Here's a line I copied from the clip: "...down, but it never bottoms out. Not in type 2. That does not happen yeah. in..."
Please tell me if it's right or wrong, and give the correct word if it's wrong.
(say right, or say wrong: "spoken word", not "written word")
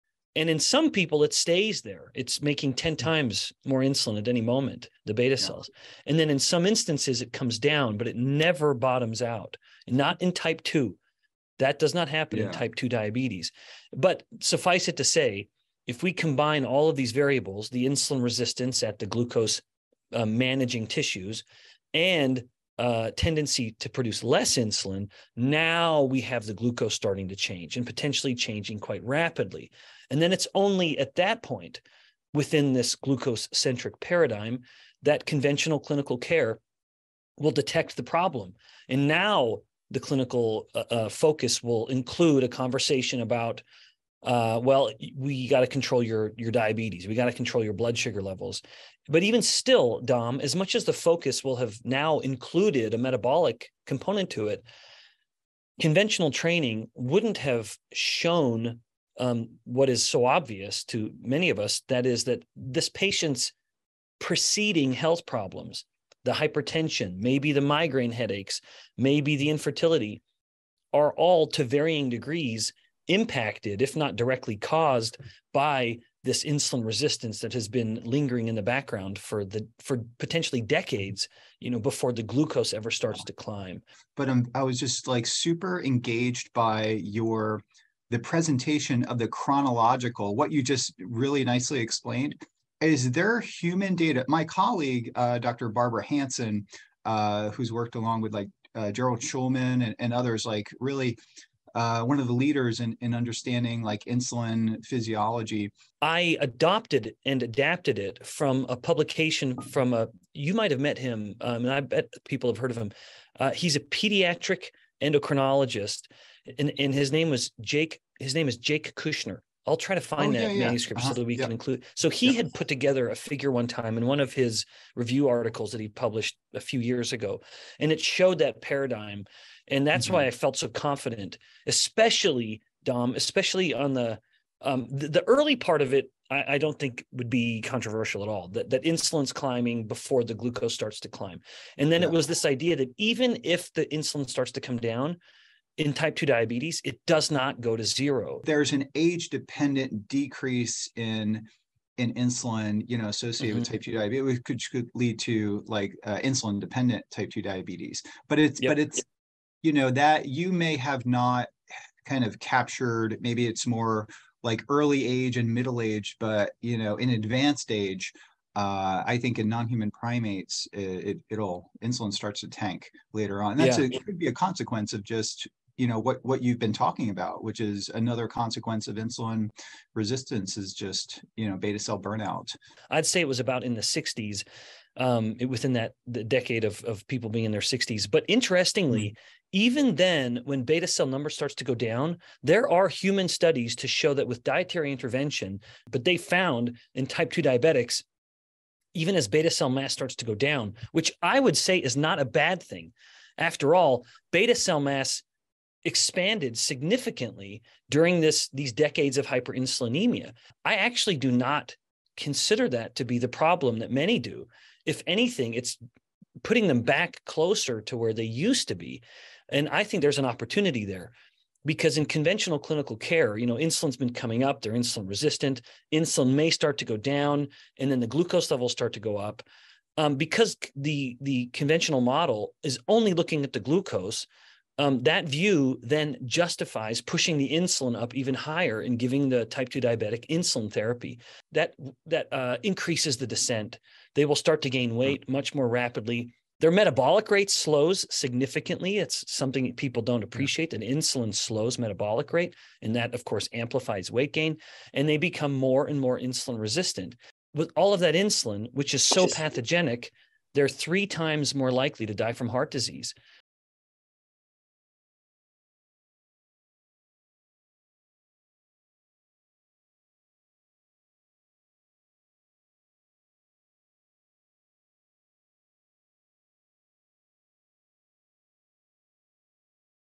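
right.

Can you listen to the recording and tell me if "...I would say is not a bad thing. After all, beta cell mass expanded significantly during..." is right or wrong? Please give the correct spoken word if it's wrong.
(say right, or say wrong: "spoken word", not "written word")
right.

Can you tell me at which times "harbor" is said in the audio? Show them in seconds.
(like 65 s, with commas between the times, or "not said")
not said.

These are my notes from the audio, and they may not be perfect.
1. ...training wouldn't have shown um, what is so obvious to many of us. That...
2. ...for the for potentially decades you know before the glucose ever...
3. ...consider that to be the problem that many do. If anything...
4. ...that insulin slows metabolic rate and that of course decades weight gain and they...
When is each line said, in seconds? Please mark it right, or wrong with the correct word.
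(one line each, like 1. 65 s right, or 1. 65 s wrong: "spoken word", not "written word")
1. 56 s right
2. 79 s right
3. 212 s right
4. 250 s wrong: "amplifies", not "decades".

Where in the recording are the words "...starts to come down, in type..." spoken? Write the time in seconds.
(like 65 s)
144 s.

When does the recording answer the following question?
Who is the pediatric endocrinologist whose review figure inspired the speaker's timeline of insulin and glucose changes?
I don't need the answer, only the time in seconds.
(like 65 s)
118 s.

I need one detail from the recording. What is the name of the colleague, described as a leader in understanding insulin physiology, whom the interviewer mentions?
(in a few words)
Barbara Hansen.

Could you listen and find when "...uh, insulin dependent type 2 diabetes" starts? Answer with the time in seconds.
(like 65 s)
156 s.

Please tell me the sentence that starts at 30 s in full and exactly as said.
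And then it's only at that point within this glucose centric paradigm that conventional clinical care will detect the problem.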